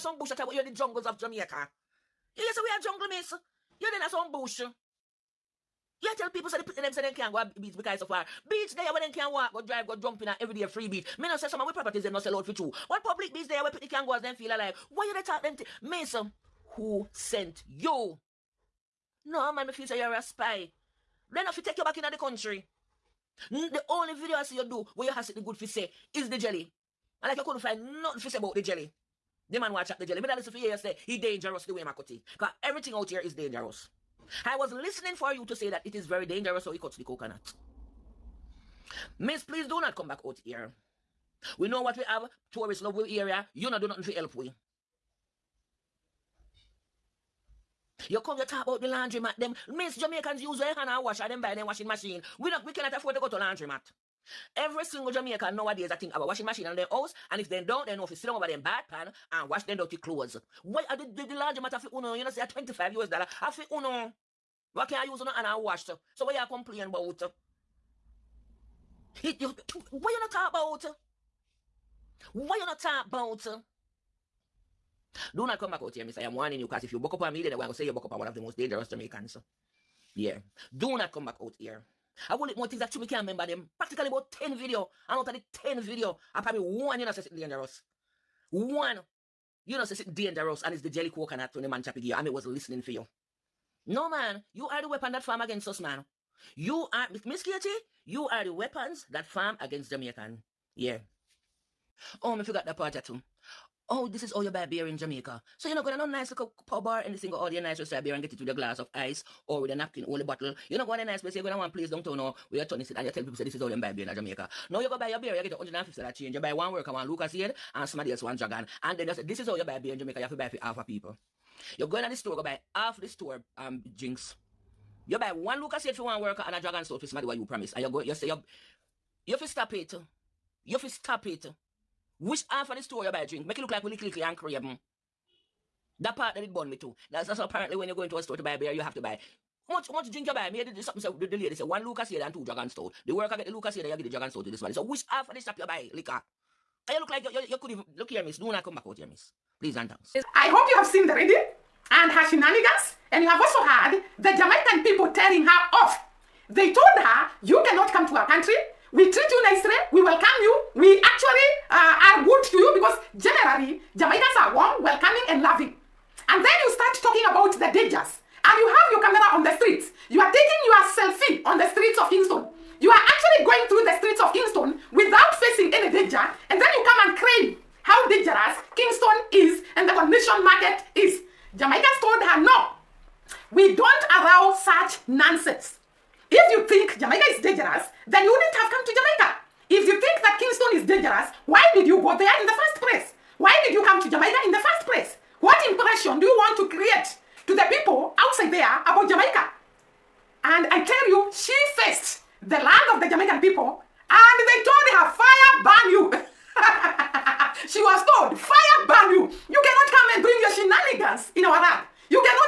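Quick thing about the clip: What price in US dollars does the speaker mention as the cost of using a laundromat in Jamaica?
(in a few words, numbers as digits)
$25.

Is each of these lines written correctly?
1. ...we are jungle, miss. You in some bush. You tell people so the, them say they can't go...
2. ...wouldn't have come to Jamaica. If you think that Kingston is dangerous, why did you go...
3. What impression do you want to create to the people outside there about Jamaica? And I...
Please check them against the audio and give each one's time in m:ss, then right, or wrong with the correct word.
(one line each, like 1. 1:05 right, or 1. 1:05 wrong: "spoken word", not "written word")
1. 0:02 right
2. 3:08 right
3. 3:15 right.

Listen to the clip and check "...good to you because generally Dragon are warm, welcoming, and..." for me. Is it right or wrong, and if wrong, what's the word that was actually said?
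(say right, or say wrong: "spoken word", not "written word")
wrong: "Jamaicans", not "Dragon".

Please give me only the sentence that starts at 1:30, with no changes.
And it's the jelly coconut when the man chappy gear.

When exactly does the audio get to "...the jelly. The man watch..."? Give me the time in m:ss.
0:28.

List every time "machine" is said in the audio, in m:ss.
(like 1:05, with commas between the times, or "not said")
0:51, 0:56.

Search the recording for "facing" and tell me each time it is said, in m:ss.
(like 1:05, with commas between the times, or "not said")
2:55.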